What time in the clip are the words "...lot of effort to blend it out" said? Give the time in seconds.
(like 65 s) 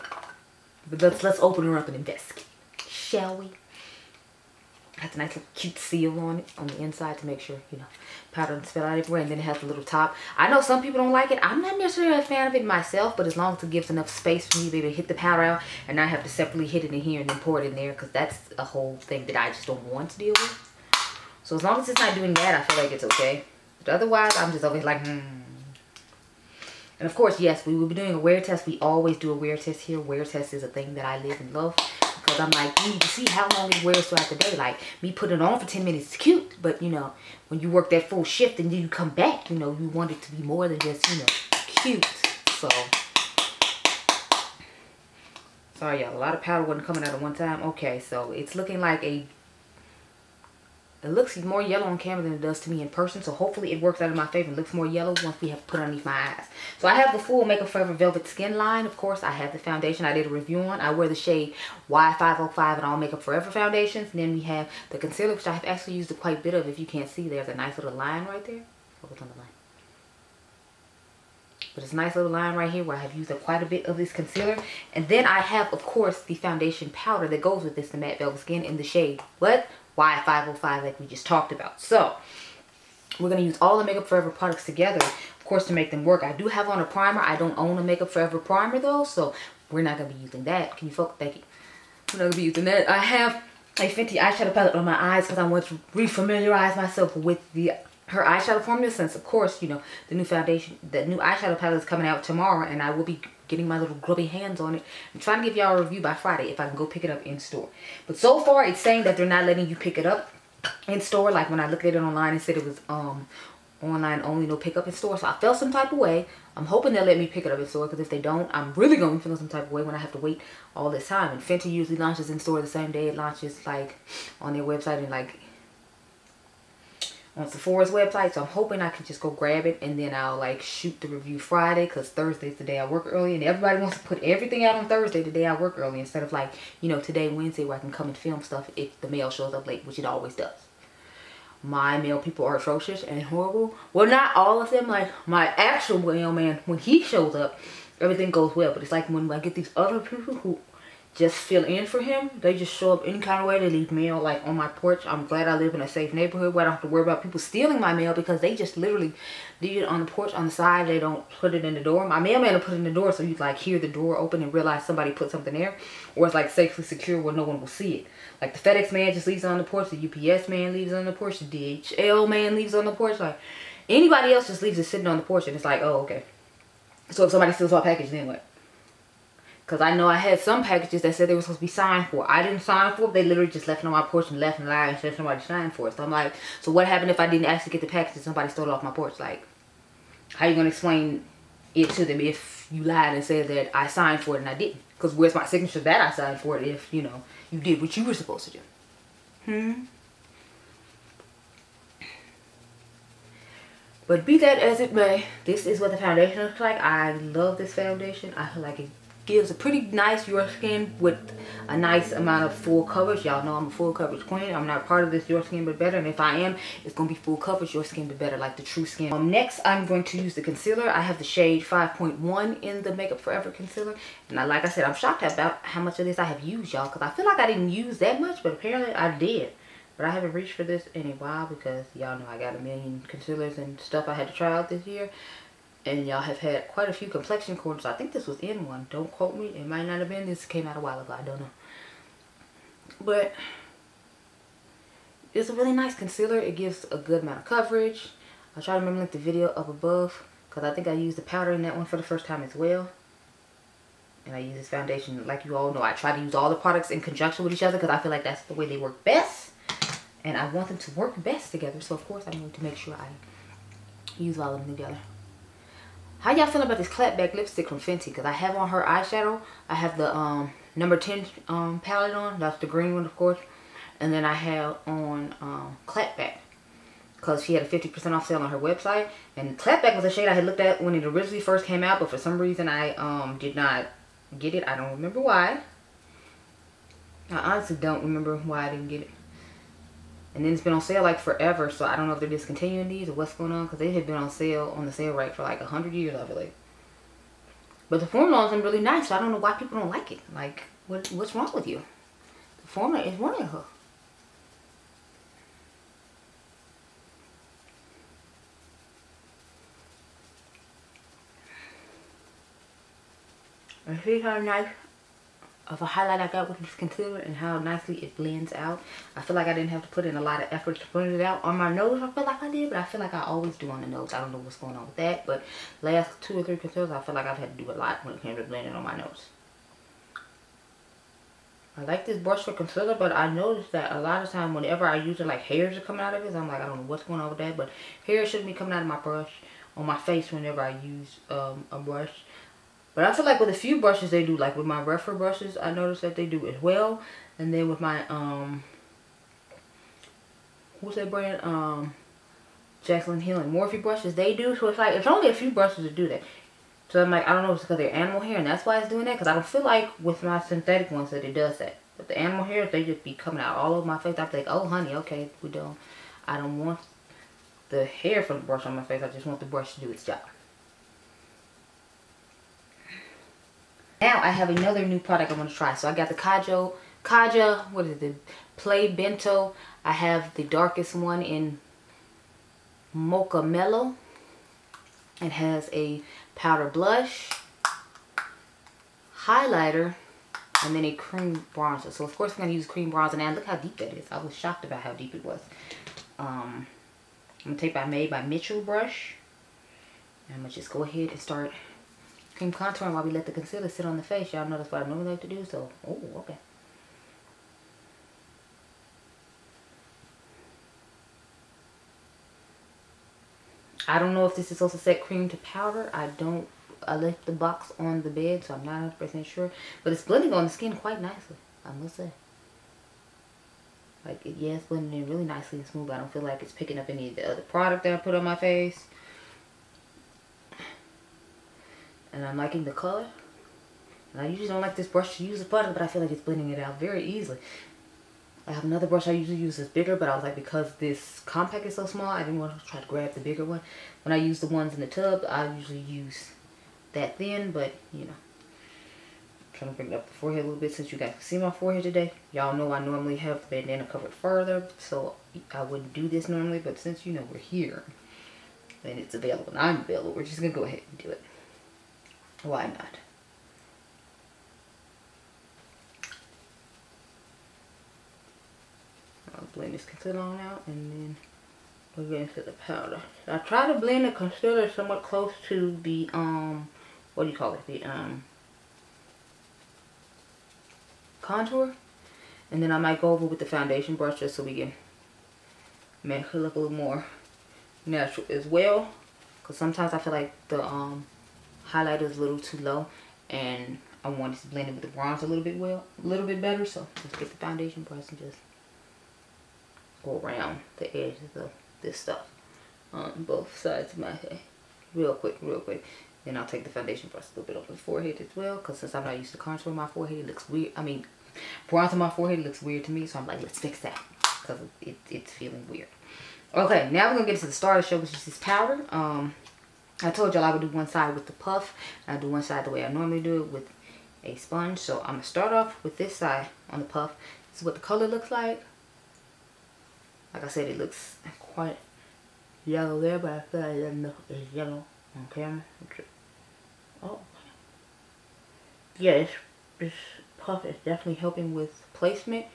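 320 s.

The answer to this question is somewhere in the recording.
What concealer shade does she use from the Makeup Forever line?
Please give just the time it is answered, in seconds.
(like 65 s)
221 s.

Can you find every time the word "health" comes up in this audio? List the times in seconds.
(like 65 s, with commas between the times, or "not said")
not said.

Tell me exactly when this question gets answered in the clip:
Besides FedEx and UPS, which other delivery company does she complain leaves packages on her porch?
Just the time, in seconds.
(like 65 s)
171 s.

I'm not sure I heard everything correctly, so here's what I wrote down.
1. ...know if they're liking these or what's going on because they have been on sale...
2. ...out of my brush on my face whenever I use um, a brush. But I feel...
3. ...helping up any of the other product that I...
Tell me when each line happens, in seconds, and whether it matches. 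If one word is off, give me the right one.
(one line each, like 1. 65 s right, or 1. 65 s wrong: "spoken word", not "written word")
1. 292 s wrong: "discontinuing", not "liking"
2. 338 s right
3. 426 s wrong: "picking", not "helping".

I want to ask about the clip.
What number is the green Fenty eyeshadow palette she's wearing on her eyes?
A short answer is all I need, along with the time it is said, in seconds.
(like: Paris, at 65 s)
10, at 270 s.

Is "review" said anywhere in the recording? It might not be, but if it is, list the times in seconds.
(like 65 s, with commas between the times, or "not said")
60 s, 105 s, 131 s.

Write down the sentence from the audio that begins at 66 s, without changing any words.
If you can't see, there's a nice little line right there.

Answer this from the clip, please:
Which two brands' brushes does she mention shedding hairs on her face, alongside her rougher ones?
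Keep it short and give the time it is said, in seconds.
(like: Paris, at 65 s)
Jaclyn Hill and Morphe, at 352 s.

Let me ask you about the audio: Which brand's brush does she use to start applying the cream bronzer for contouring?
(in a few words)
Made by Mitchell.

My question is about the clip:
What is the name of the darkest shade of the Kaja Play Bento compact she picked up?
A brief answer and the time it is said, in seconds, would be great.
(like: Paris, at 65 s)
Mocha Mellow, at 382 s.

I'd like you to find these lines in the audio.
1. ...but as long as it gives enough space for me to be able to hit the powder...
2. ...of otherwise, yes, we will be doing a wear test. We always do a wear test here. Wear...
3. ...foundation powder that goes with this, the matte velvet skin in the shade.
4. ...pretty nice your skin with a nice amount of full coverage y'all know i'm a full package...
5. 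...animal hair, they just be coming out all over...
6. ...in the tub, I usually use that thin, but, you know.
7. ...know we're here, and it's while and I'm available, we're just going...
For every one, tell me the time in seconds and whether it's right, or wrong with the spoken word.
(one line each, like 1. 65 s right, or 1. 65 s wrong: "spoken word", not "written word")
1. 13 s right
2. 27 s wrong: "course", not "otherwise"
3. 76 s right
4. 209 s wrong: "coverage", not "package"
5. 362 s right
6. 444 s right
7. 457 s wrong: "available", not "while".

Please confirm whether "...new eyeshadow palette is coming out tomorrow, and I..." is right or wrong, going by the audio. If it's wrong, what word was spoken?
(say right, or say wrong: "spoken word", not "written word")
right.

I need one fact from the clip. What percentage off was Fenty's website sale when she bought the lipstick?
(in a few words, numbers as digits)
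50%.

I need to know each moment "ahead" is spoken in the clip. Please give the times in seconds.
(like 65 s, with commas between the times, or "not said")
400 s, 460 s.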